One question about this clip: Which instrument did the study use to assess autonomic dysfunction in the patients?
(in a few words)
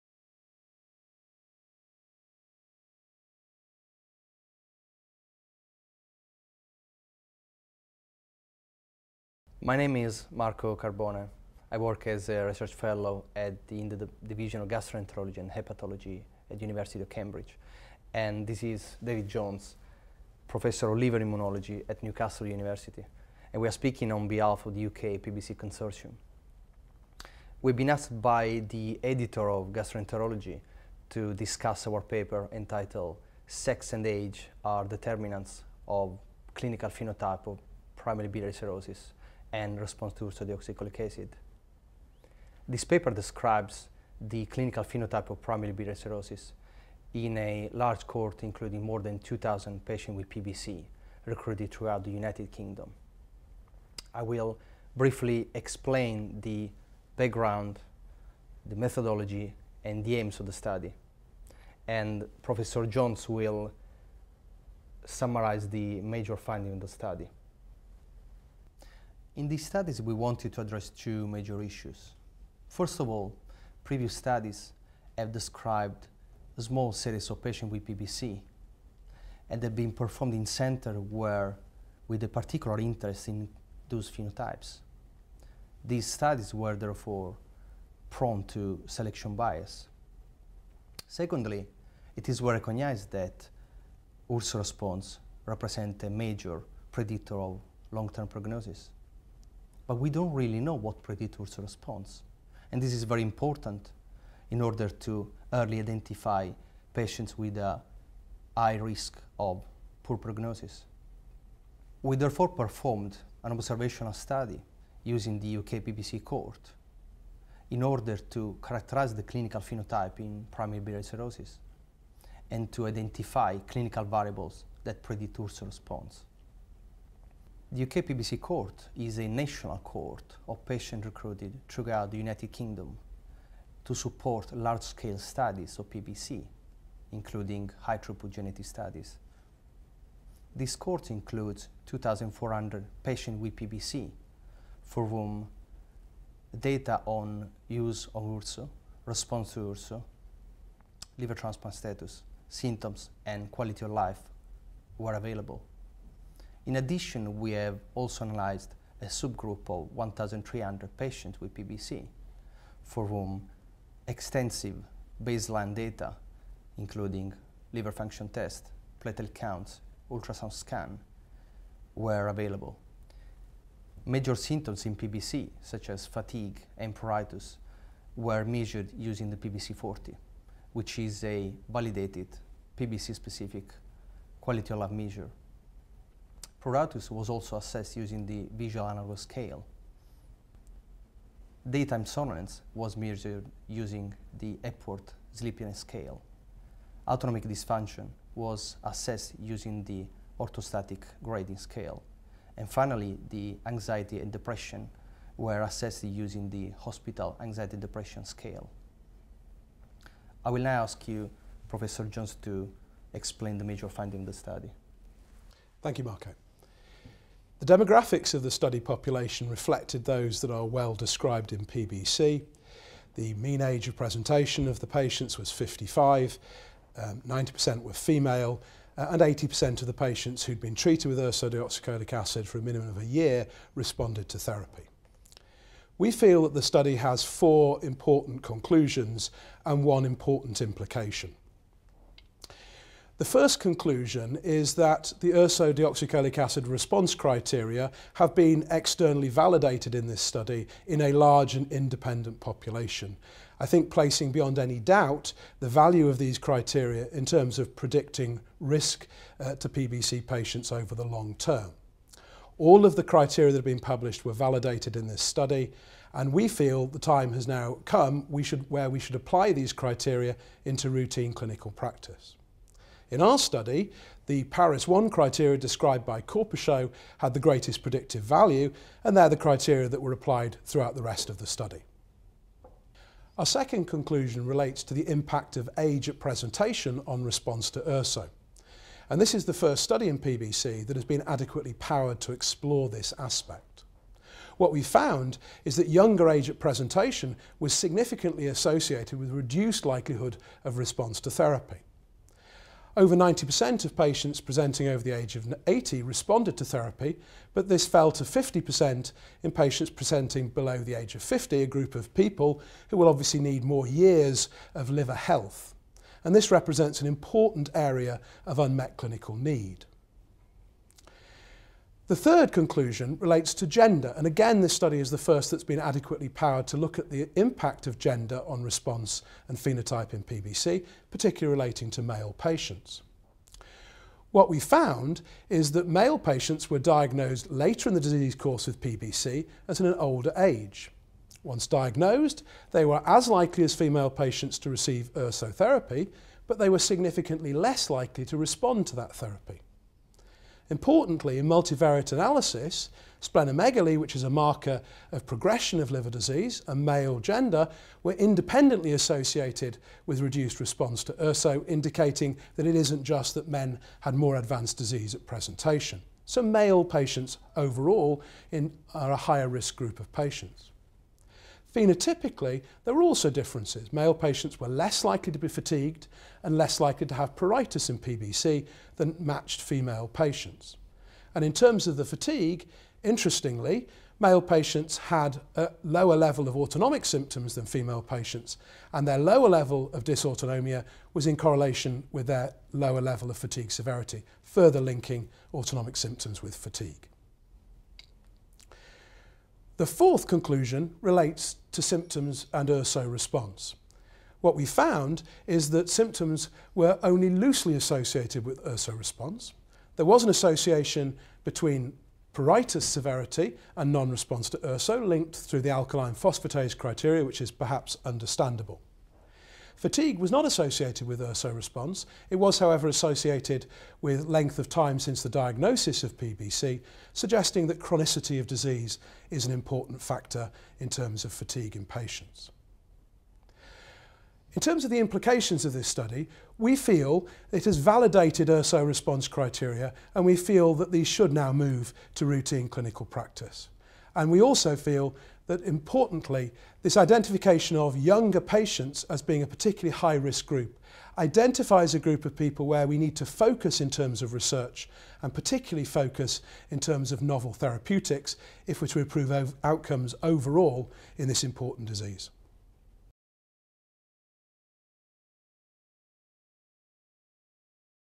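Orthostatic grading scale.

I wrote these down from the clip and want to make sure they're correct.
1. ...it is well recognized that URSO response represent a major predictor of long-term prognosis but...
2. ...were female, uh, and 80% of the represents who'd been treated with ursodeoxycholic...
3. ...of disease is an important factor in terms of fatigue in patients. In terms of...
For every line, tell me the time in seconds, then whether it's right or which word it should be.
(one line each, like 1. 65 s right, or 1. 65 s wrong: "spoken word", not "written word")
1. 92 s right
2. 227 s wrong: "patients", not "represents"
3. 428 s right.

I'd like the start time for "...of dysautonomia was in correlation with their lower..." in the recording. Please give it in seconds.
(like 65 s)
389 s.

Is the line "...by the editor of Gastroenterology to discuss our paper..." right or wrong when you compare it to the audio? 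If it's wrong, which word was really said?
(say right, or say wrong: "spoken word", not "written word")
right.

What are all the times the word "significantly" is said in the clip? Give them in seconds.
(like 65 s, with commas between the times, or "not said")
297 s, 346 s.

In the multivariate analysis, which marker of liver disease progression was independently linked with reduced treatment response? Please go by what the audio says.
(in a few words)
Splenomegaly.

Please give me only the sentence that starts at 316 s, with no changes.
And this represents an important area of unmet clinical need.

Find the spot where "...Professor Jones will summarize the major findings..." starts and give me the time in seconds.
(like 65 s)
62 s.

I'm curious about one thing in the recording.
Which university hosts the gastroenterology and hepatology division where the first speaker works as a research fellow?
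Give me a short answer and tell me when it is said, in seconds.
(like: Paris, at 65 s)
University of Cambridge, at 16 s.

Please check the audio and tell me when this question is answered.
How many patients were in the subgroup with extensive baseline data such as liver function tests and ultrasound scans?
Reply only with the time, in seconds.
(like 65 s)
159 s.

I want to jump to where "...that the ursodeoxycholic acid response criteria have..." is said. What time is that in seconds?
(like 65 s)
244 s.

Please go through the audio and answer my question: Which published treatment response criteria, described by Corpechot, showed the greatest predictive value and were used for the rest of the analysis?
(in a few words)
Paris 1.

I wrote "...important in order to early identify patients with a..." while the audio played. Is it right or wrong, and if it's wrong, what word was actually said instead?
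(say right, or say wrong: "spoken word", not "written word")
right.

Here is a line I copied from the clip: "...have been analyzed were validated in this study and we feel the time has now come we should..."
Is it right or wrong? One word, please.
wrong.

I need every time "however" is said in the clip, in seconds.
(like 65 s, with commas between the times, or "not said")
422 s.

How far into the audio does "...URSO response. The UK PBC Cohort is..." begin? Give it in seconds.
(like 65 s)
125 s.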